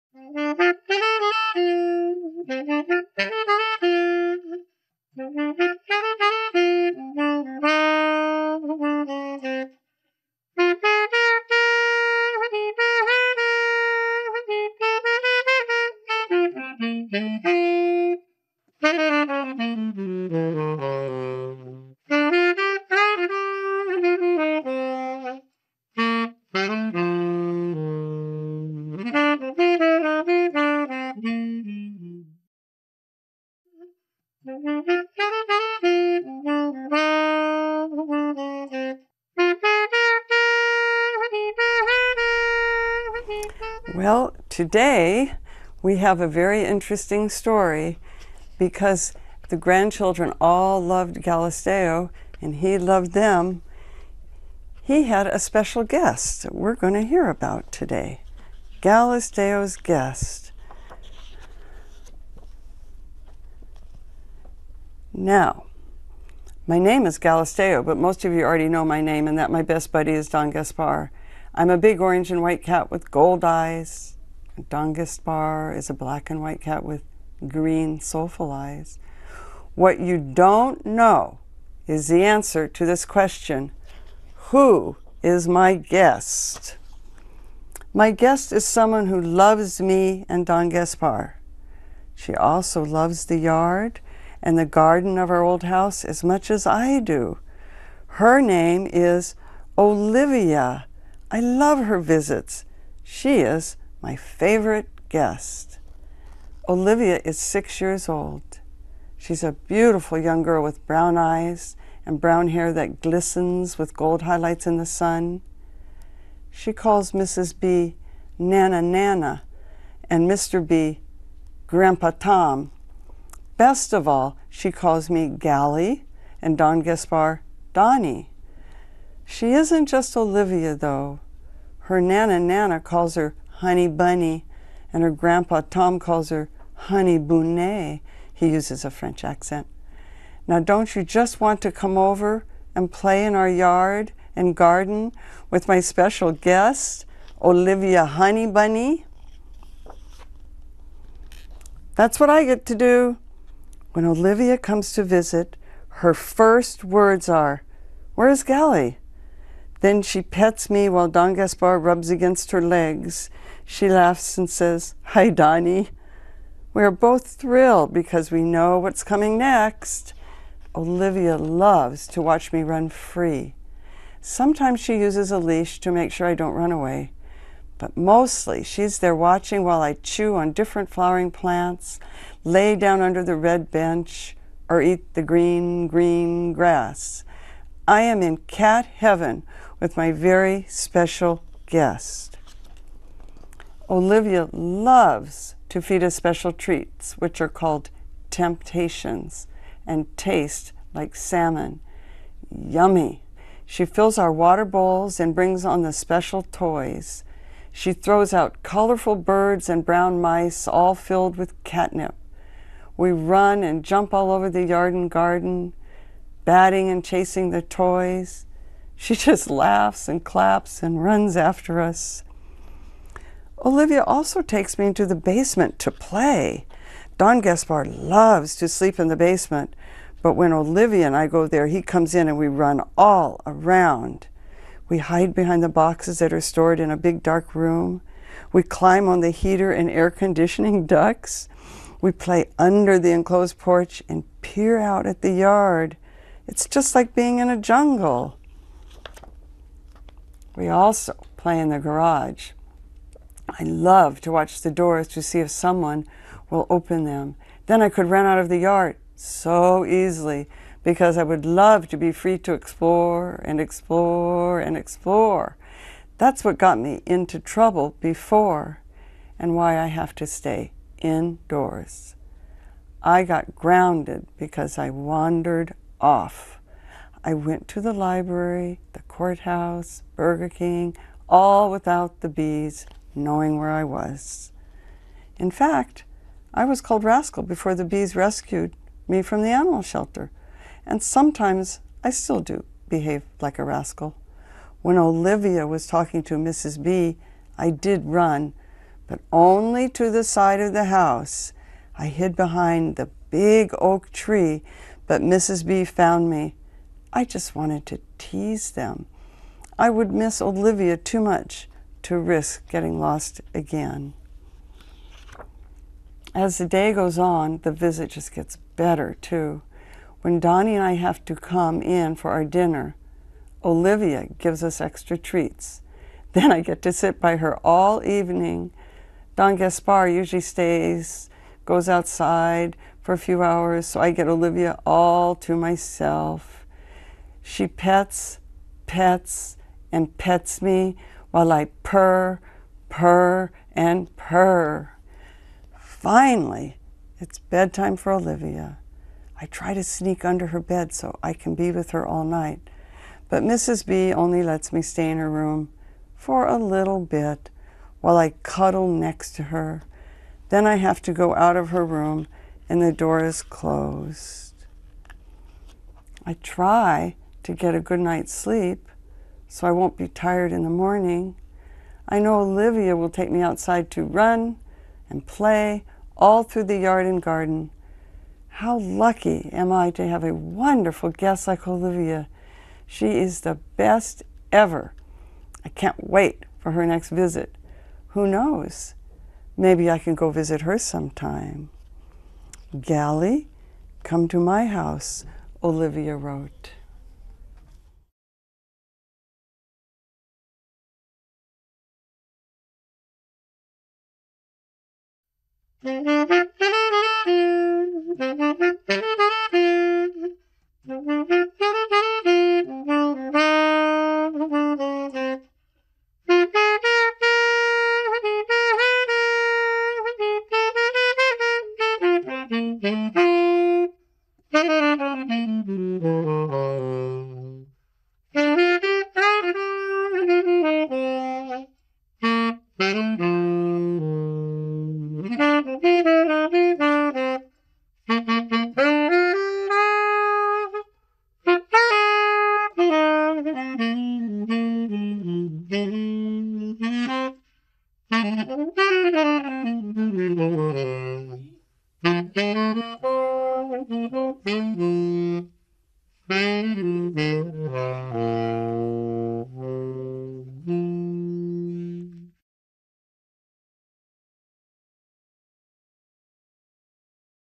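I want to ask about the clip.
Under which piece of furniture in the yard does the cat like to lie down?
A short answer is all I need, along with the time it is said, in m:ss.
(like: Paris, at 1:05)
the red bench, at 3:03.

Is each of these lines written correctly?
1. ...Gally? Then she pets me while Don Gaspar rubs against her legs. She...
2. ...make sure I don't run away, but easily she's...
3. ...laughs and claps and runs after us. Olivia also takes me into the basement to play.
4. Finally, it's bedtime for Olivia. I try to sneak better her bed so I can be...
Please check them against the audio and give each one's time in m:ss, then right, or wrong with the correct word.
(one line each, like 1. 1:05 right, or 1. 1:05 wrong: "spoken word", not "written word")
1. 2:38 right
2. 2:55 wrong: "mostly", not "easily"
3. 3:39 right
4. 5:45 wrong: "under", not "better".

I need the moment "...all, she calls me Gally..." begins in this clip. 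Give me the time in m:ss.
2:04.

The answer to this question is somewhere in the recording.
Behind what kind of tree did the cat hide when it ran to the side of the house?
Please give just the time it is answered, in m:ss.
5:03.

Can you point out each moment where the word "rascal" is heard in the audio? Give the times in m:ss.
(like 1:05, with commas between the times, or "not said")
4:47, 4:53.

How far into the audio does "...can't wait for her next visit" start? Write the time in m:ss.
6:25.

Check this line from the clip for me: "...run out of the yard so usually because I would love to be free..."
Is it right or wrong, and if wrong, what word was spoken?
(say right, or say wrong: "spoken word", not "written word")
wrong: "easily", not "usually".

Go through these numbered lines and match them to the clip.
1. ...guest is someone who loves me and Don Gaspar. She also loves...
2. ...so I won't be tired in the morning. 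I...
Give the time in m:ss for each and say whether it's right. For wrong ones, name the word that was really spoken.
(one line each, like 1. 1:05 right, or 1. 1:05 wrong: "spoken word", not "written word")
1. 1:28 right
2. 6:09 right.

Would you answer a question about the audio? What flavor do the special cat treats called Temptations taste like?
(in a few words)
salmon.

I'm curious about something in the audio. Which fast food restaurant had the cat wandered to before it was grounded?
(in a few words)
Burger King.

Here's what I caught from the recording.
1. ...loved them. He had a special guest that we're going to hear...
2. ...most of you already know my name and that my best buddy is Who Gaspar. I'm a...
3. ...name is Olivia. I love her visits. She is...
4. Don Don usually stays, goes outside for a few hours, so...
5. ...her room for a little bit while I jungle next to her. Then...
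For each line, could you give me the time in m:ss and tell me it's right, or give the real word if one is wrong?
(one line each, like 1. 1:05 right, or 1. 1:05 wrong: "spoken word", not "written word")
1. 0:52 right
2. 1:07 wrong: "Don", not "Who"
3. 1:38 right
4. 5:29 wrong: "Gaspar", not "Don"
5. 5:55 wrong: "cuddle", not "jungle".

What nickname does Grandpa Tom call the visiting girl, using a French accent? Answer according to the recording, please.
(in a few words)
Honey Bounet.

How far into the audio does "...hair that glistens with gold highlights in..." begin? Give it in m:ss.
1:52.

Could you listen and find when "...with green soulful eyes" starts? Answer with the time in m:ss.
1:16.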